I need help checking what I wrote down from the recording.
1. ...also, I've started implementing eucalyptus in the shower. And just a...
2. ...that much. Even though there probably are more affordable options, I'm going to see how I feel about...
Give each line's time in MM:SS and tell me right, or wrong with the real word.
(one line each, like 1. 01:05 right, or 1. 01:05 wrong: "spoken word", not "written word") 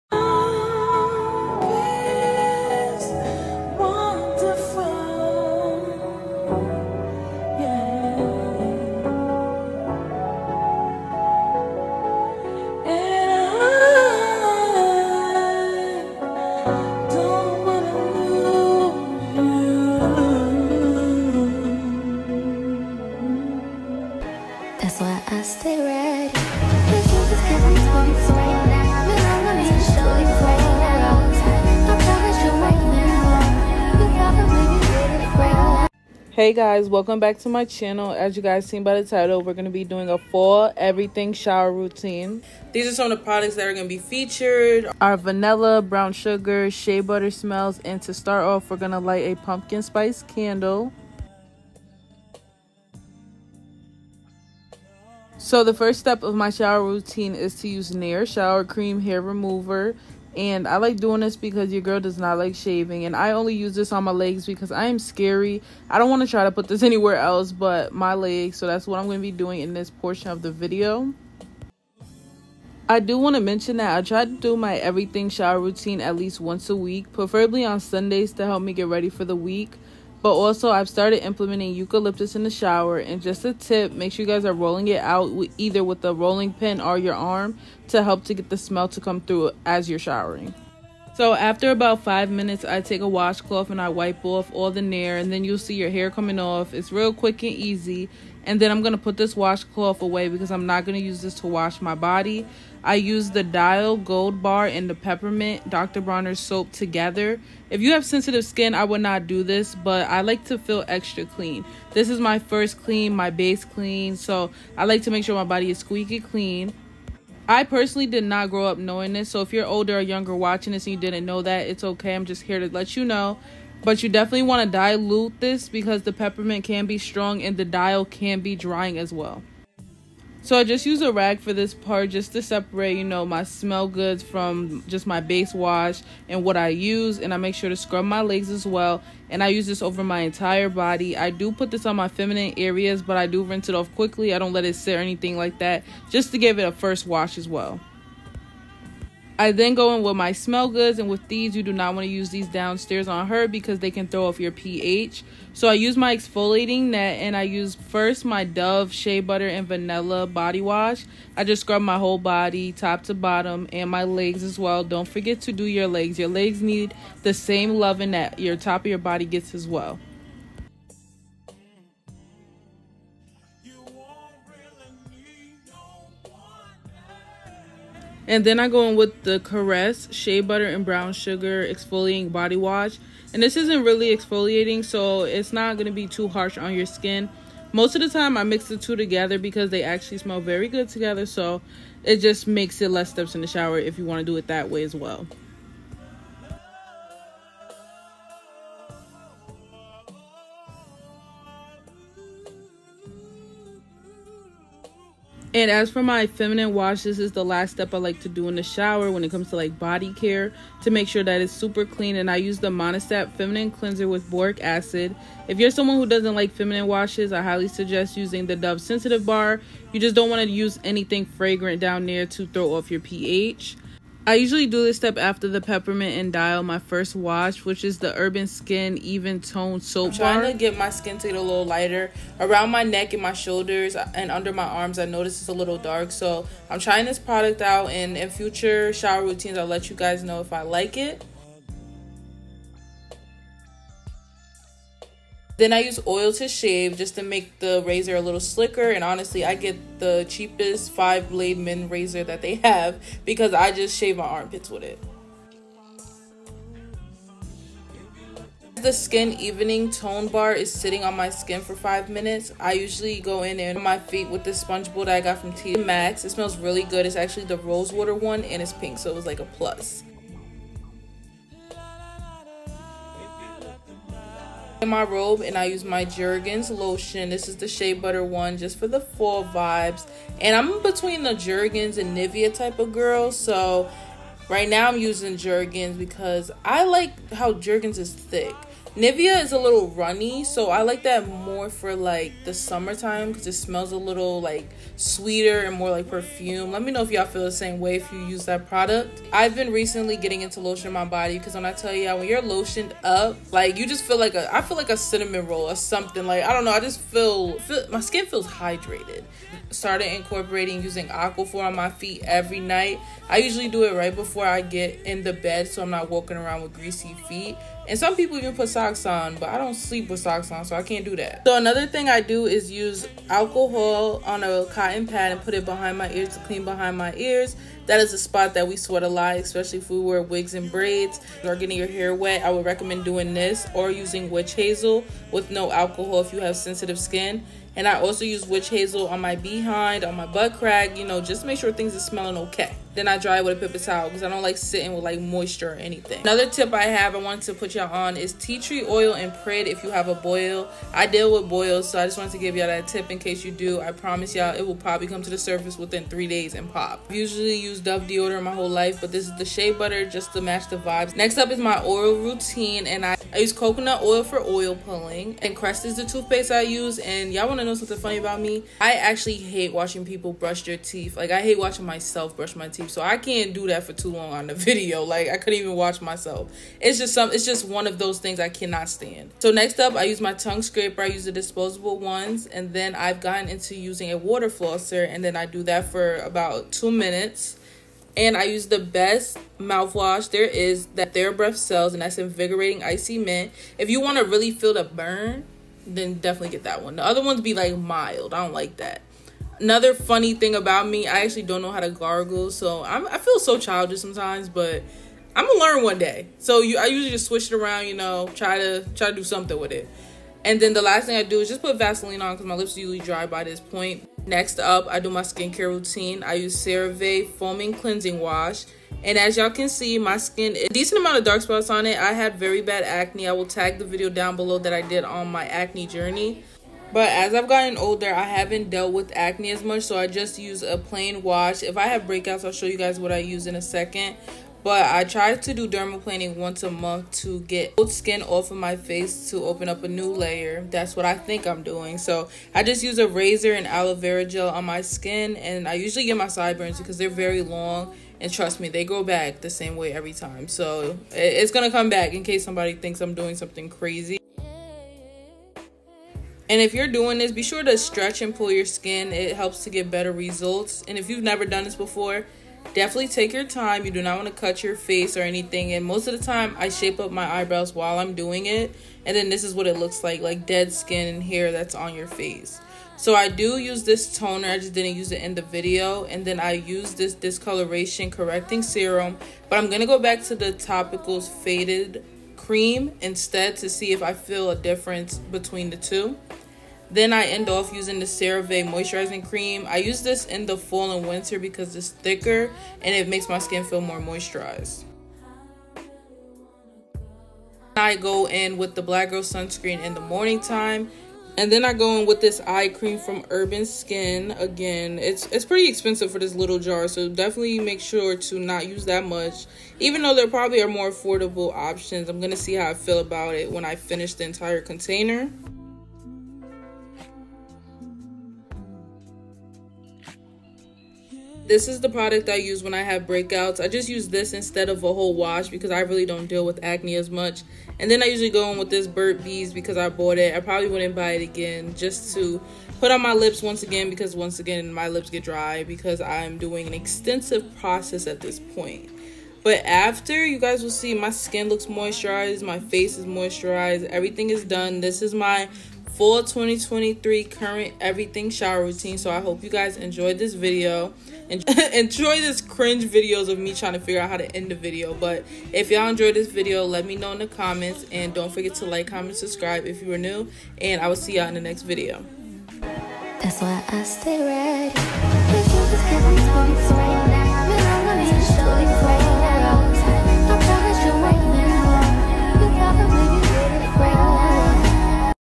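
1. 01:20 right
2. 08:28 right.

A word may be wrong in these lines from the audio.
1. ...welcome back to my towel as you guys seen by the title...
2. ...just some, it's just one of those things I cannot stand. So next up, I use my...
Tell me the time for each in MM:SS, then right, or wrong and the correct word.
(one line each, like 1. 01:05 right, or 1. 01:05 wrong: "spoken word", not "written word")
1. 00:36 wrong: "channel", not "towel"
2. 06:16 right.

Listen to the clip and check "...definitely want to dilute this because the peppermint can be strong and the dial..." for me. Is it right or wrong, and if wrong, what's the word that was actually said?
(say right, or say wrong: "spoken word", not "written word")
right.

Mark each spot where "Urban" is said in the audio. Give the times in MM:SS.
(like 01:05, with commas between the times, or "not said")
03:48, 08:23.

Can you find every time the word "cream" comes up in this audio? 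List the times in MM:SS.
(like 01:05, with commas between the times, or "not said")
00:58, 08:02, 08:09, 08:22.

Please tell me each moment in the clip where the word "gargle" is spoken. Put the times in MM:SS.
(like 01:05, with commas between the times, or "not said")
06:41.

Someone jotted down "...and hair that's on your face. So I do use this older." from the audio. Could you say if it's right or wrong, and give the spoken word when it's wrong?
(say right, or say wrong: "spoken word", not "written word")
wrong: "toner", not "older".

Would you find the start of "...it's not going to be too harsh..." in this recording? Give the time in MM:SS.
03:05.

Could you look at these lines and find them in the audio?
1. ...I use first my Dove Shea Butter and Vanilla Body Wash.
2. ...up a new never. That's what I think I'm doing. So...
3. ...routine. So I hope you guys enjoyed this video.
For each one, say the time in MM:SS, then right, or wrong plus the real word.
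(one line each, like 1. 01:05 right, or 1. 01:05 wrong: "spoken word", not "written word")
1. 02:37 right
2. 07:19 wrong: "layer", not "never"
3. 09:08 right.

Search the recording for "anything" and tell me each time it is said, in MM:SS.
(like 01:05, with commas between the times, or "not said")
02:24, 03:40, 05:45, 07:45.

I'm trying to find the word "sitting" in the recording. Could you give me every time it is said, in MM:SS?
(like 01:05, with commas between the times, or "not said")
04:20, 05:44.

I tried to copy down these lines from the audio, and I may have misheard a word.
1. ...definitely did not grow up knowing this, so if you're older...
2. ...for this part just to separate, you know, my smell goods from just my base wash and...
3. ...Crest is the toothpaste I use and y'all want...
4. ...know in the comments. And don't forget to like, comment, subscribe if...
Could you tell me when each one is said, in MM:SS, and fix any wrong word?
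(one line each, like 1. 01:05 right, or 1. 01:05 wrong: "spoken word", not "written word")
1. 01:57 wrong: "personally", not "definitely"
2. 02:11 right
3. 06:05 right
4. 09:16 right.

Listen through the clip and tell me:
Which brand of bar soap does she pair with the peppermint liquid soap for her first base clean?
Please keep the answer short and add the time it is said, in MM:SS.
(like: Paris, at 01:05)
Dial Gold, at 01:43.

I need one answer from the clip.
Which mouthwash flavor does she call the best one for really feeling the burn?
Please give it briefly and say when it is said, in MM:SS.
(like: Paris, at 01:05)
Invigorating Icy Mint, at 06:32.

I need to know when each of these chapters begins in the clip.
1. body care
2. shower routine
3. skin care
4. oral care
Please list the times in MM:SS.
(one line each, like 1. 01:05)
1. 04:35
2. 00:38
3. 06:53
4. 05:40.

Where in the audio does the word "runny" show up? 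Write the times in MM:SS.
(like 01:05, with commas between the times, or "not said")
04:49.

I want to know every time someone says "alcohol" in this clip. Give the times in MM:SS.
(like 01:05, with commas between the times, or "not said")
05:23, 05:35.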